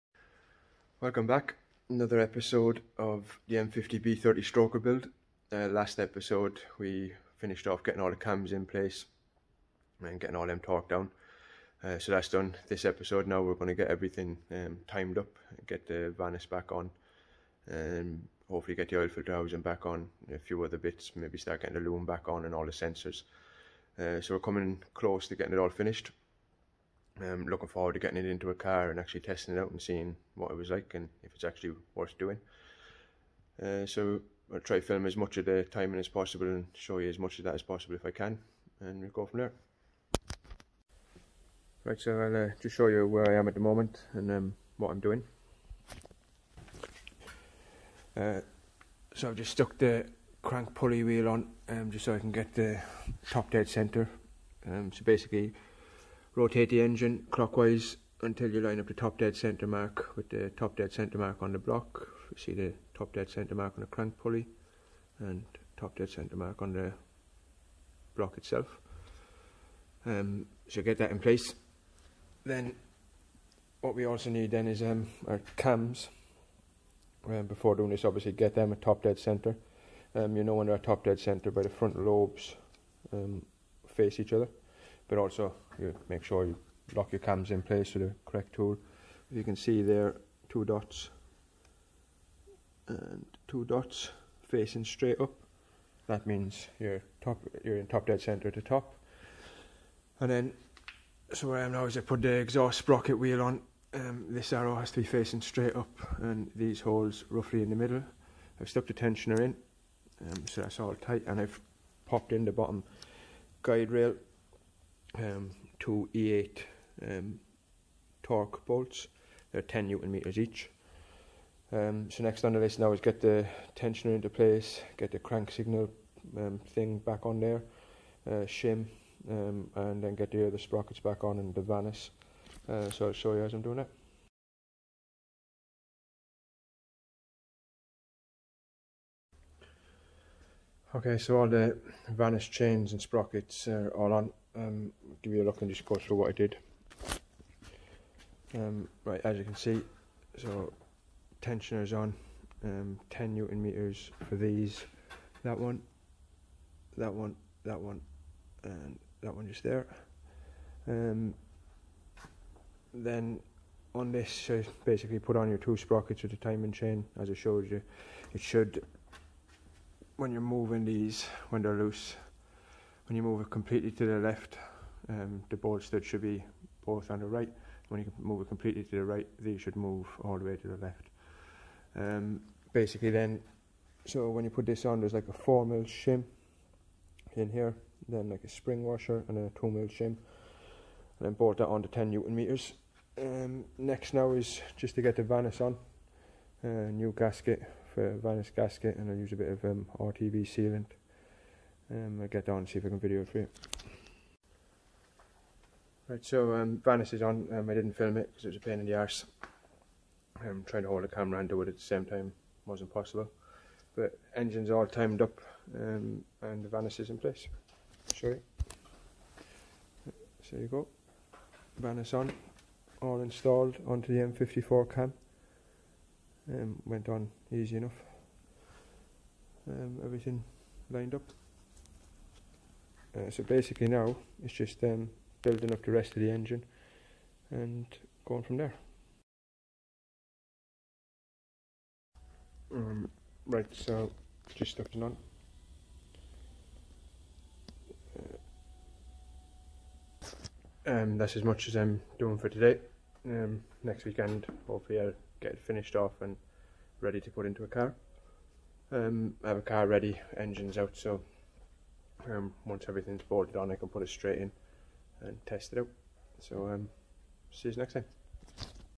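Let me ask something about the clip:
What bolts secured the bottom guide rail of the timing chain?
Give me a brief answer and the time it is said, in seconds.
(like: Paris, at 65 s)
E8 Torx, at 116 s.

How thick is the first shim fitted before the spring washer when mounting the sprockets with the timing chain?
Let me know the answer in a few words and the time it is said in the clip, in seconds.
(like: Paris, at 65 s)
4 mm, at 185 s.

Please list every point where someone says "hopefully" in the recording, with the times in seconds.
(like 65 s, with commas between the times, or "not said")
18 s, 254 s.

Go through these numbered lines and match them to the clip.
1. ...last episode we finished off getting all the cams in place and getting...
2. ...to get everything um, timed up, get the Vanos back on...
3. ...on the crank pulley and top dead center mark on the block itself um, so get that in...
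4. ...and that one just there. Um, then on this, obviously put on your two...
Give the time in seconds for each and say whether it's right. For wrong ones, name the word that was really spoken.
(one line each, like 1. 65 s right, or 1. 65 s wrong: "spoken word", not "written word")
1. 5 s right
2. 13 s right
3. 63 s right
4. 158 s wrong: "basically", not "obviously".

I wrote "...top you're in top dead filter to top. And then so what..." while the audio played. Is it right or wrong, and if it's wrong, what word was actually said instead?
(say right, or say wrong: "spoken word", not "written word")
wrong: "center", not "filter".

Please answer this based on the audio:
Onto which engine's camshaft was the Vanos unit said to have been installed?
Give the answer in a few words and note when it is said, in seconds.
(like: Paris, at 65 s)
M54, at 224 s.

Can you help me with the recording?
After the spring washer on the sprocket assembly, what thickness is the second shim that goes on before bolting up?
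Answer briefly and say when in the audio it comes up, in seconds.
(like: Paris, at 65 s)
2 mm, at 189 s.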